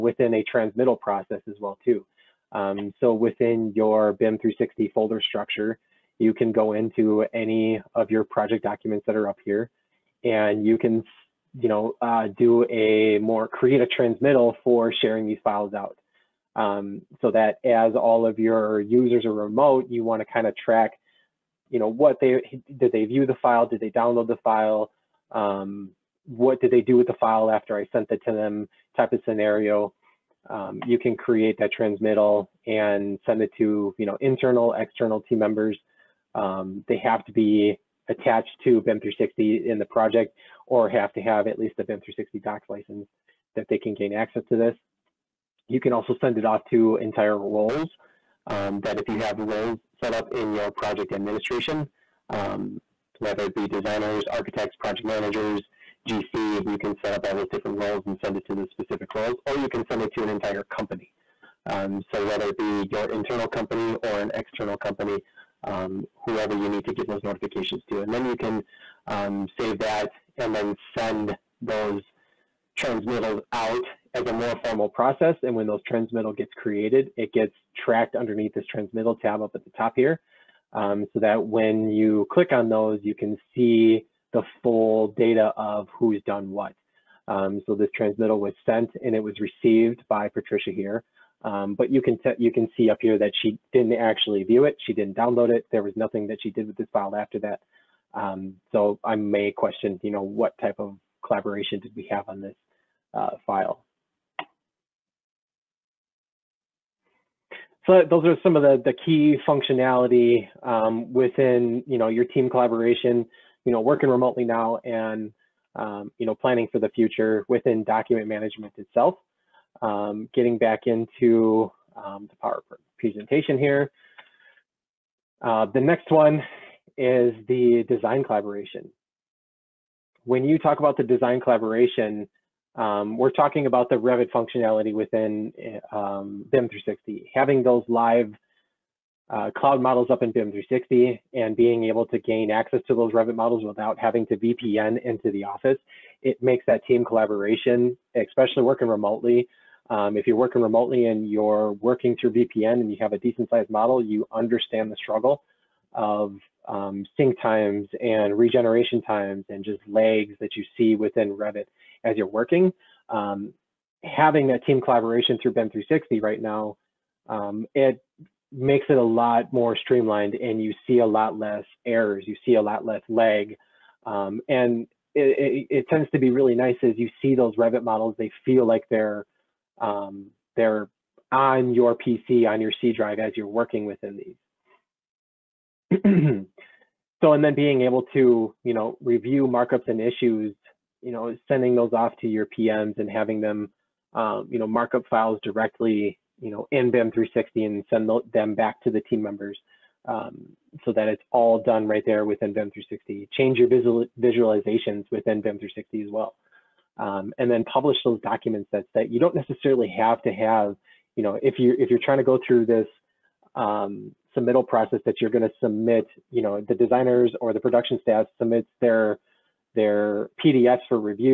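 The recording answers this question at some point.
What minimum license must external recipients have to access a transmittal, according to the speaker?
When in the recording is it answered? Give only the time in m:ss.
0:41.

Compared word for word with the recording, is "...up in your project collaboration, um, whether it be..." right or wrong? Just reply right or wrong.
wrong.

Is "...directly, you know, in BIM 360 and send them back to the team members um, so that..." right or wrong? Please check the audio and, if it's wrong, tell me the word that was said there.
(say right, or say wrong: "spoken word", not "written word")
right.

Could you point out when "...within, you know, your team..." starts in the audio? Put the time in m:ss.
1:51.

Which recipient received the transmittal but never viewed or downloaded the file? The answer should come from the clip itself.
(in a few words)
Patricia.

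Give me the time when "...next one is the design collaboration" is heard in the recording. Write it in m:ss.
2:05.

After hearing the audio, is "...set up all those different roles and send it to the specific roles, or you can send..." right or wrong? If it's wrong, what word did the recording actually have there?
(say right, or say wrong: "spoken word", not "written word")
right.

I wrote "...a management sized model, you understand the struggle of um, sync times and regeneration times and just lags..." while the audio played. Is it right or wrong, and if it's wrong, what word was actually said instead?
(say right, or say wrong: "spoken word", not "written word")
wrong: "decent", not "management".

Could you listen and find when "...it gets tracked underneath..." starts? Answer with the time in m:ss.
1:17.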